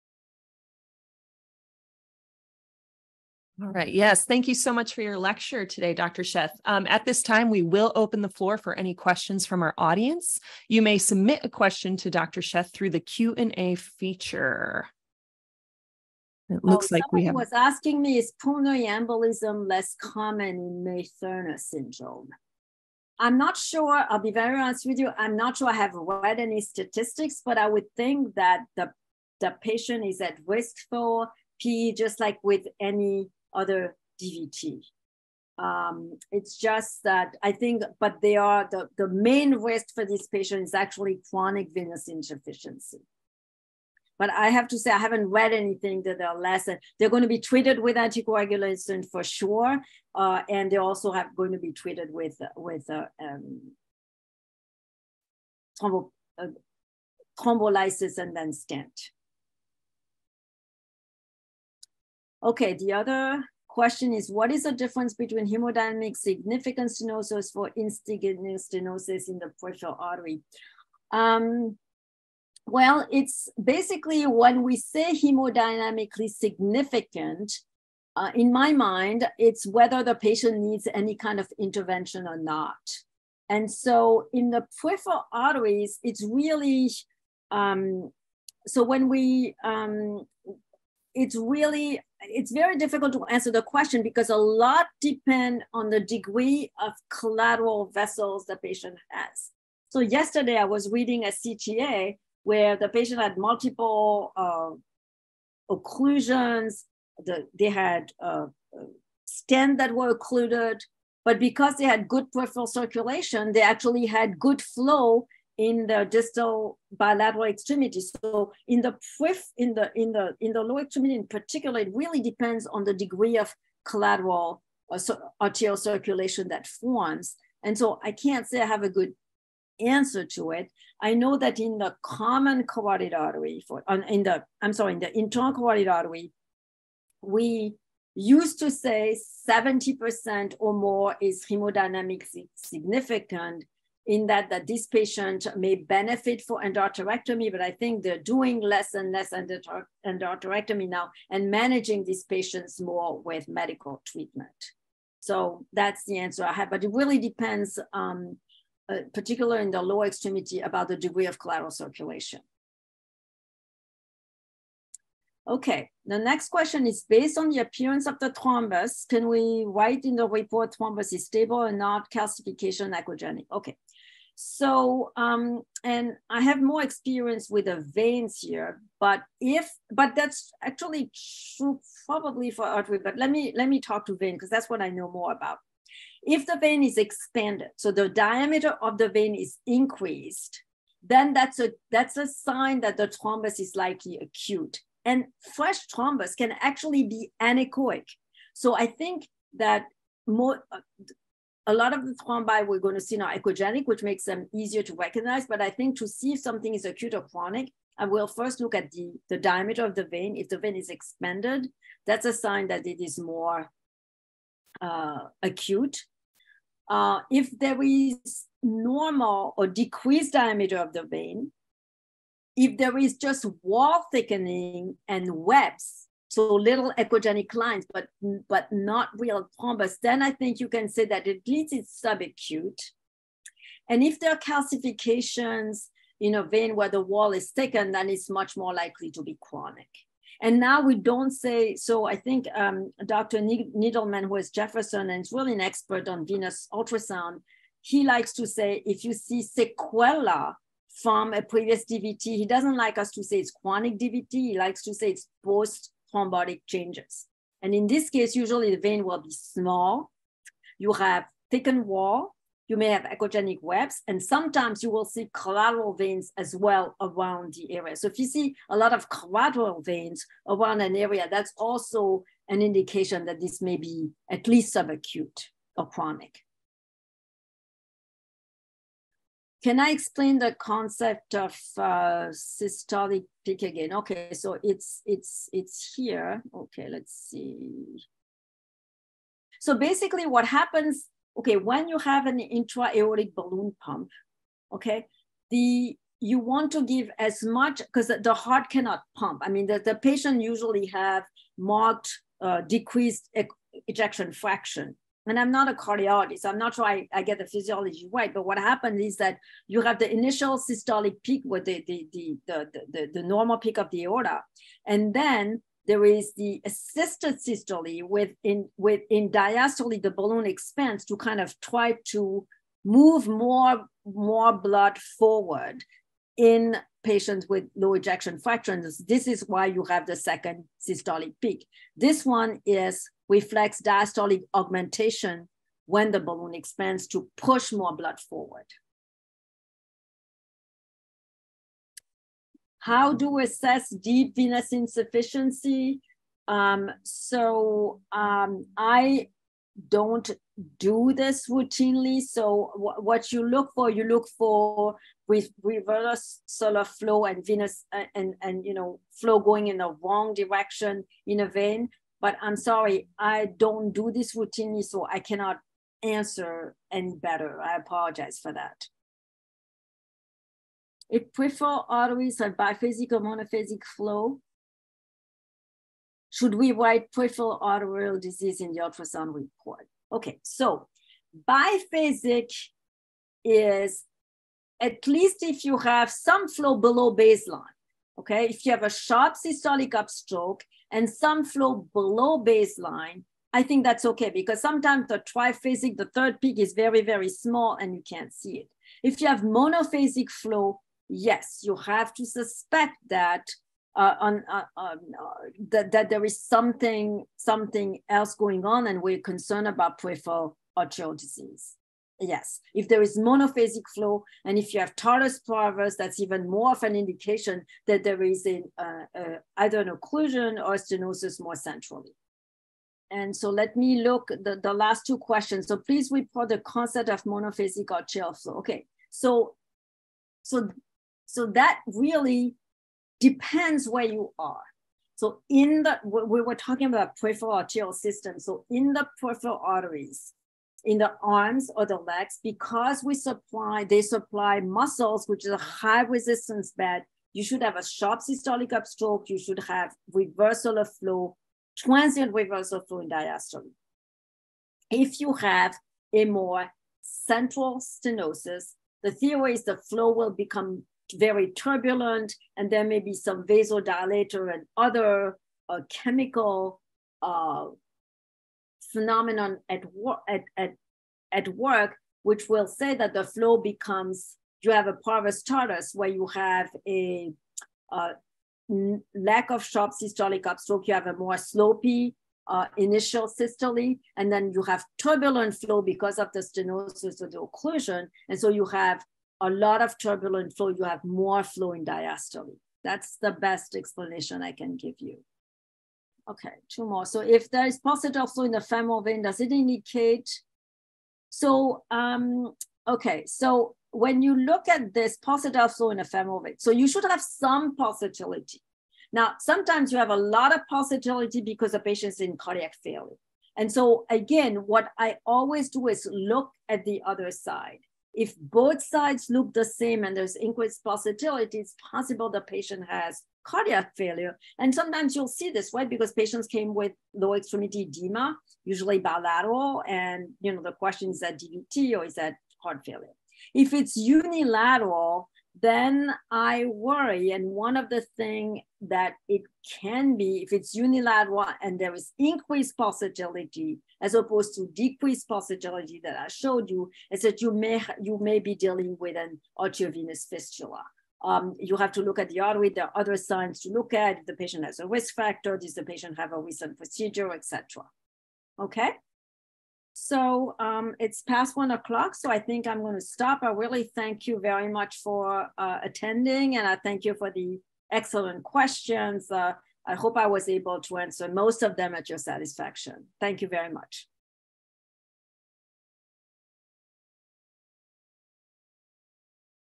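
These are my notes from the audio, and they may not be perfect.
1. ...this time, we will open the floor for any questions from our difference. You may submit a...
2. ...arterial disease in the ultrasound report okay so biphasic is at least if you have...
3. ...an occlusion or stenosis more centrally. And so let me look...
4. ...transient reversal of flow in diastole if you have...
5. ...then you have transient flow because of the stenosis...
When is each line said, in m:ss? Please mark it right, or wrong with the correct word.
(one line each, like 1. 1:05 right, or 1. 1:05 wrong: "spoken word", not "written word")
1. 0:07 wrong: "audience", not "difference"
2. 6:17 right
3. 6:59 right
4. 7:31 right
5. 8:04 wrong: "turbulent", not "transient".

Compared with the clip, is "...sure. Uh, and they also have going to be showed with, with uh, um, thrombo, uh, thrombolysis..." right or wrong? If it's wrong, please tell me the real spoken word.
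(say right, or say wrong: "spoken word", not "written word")
wrong: "treated", not "showed".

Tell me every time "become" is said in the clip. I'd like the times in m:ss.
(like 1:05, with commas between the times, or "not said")
7:40, 7:53.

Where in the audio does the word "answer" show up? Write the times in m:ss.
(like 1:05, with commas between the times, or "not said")
1:33, 2:09, 2:36, 6:06, 9:30.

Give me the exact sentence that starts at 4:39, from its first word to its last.
can I explain the concept of uh, systolic peak again?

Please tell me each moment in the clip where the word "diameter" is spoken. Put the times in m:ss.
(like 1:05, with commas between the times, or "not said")
3:08, 3:29, 3:40.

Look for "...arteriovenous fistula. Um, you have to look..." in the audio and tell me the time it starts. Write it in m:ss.
9:09.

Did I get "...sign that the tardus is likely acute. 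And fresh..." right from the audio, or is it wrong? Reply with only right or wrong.
wrong.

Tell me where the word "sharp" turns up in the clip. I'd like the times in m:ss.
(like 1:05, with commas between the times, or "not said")
6:28, 7:27, 7:59.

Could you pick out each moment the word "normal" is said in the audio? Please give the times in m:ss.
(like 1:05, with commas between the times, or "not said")
3:38, 5:13.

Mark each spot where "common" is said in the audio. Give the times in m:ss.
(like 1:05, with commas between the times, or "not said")
0:20, 2:12.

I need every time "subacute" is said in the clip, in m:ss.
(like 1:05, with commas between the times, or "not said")
3:52, 4:34.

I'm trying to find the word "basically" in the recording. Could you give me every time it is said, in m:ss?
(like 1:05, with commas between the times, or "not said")
1:13, 4:49.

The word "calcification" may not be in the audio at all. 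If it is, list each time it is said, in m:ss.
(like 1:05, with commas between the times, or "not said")
2:52, 3:54.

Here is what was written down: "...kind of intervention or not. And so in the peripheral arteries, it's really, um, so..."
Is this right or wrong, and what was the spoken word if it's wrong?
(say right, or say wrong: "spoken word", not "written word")
right.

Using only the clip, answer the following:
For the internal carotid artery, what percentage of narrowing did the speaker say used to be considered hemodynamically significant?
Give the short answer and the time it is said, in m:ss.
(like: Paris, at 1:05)
70%, at 2:19.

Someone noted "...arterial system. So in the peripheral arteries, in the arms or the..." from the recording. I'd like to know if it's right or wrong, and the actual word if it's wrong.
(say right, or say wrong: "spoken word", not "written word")
right.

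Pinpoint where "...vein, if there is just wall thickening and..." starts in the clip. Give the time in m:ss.
3:41.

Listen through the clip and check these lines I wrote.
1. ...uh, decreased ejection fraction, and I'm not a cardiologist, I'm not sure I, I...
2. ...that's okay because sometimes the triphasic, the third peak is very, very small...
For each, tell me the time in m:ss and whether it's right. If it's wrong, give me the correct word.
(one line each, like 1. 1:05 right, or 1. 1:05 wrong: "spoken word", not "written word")
1. 5:02 right
2. 6:33 right.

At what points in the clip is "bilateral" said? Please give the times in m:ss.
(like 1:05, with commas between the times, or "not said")
1:56, 8:48.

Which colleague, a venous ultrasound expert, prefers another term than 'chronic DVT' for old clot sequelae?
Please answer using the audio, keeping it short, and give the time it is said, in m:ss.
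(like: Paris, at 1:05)
Dr. Needleman, at 4:03.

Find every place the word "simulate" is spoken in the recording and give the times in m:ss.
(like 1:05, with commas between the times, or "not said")
not said.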